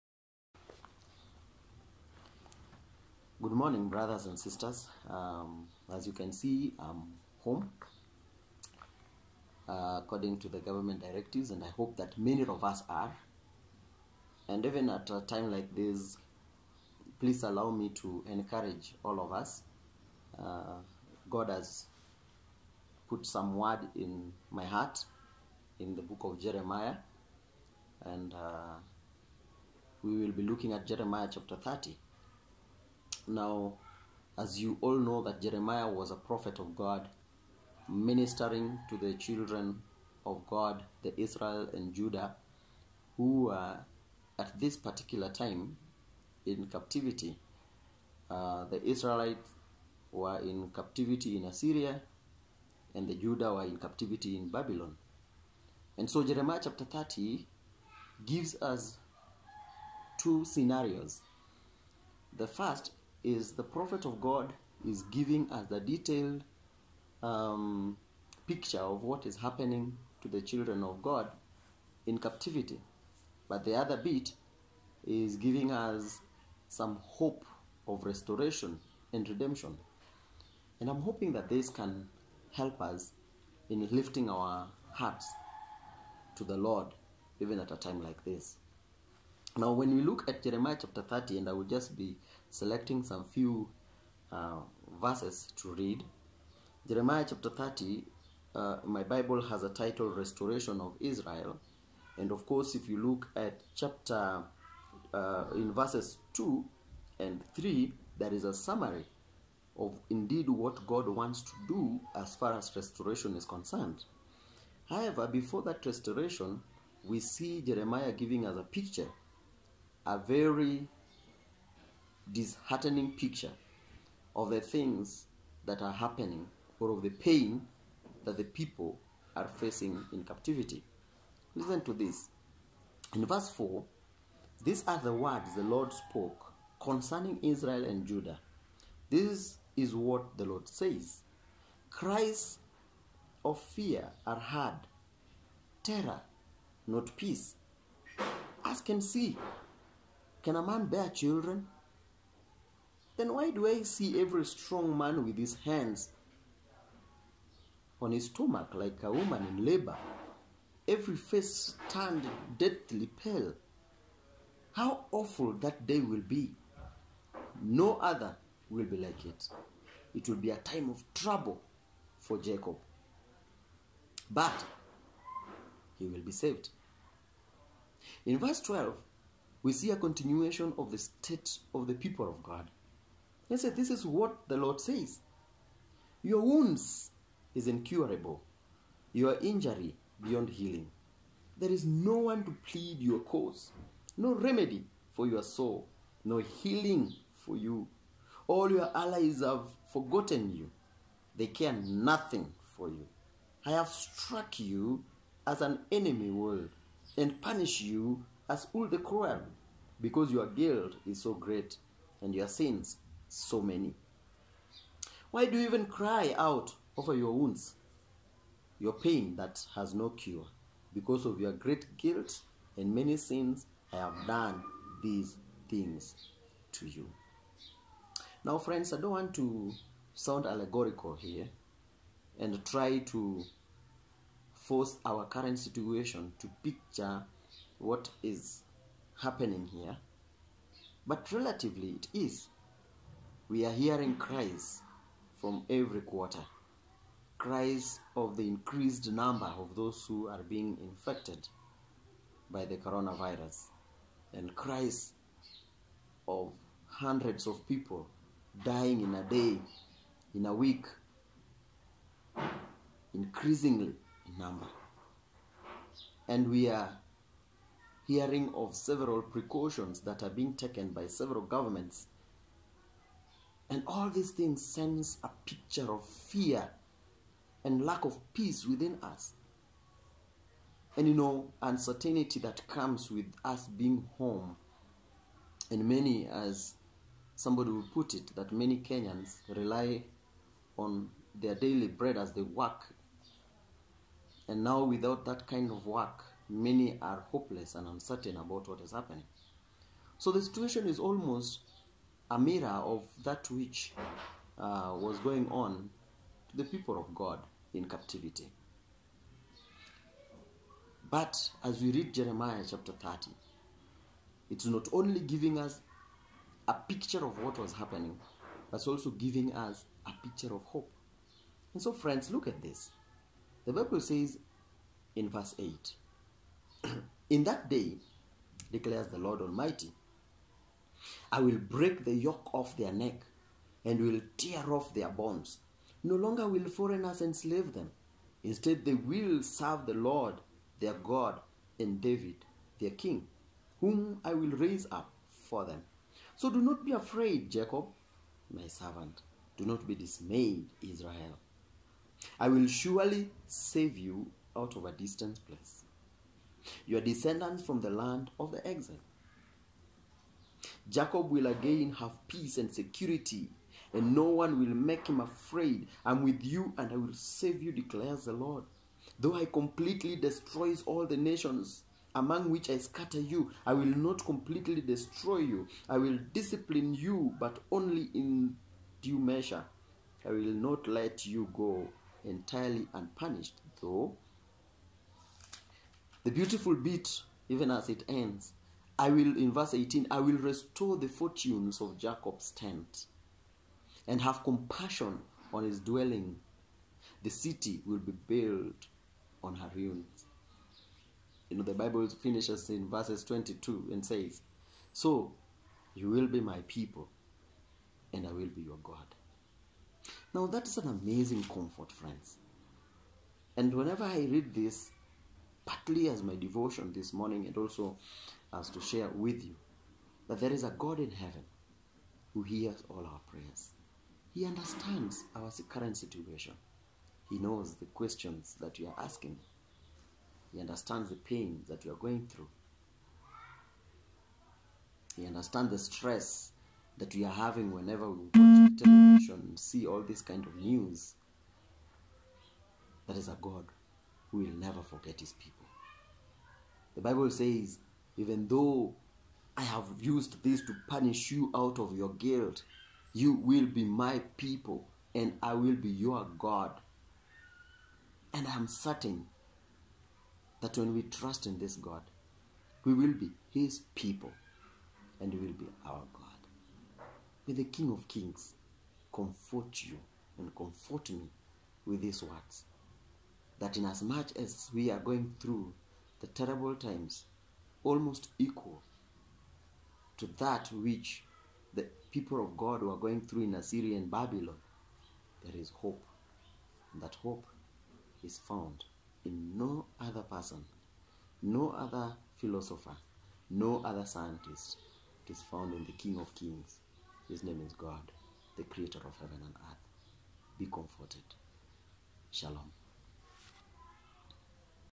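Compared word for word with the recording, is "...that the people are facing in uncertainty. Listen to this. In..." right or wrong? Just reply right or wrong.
wrong.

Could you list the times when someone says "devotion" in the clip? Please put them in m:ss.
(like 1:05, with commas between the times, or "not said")
6:56.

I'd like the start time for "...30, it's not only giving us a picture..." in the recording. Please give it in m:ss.
5:12.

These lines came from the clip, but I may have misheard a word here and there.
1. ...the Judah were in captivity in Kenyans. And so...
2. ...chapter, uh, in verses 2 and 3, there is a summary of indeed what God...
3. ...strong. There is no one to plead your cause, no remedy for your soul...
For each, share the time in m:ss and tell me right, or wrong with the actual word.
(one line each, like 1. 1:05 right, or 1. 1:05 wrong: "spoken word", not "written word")
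1. 0:53 wrong: "Babylon", not "Kenyans"
2. 1:43 right
3. 3:10 wrong: "healing", not "strong".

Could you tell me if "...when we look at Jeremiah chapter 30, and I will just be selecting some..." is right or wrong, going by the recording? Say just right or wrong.
right.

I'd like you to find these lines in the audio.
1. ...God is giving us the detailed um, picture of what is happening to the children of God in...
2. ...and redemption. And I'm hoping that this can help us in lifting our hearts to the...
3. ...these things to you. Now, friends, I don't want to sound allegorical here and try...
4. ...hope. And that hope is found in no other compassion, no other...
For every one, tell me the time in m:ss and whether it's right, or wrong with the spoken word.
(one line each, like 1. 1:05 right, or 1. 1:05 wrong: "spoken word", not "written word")
1. 1:04 right
2. 1:19 right
3. 3:45 right
4. 8:05 wrong: "person", not "compassion".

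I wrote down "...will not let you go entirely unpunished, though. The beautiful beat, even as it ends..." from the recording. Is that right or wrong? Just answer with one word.
right.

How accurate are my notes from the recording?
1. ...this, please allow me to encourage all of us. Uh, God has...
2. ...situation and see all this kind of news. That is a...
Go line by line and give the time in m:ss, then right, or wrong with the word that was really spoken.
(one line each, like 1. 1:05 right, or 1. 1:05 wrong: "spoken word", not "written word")
1. 0:15 right
2. 7:18 wrong: "television", not "situation".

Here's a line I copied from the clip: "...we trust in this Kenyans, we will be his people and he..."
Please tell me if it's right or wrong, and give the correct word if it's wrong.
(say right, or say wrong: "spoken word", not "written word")
wrong: "God", not "Kenyans".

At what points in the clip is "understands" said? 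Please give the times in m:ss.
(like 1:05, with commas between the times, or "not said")
7:04, 7:10, 7:15.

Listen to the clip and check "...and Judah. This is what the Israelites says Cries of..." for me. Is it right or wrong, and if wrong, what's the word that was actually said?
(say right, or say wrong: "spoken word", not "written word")
wrong: "Lord", not "Israelites".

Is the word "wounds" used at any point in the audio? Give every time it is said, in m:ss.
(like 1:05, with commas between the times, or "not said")
3:06, 3:37.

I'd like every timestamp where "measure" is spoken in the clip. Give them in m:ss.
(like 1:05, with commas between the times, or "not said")
6:19.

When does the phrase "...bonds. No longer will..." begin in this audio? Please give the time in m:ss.
5:35.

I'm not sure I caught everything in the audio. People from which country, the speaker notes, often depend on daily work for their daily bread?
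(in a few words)
Kenyans.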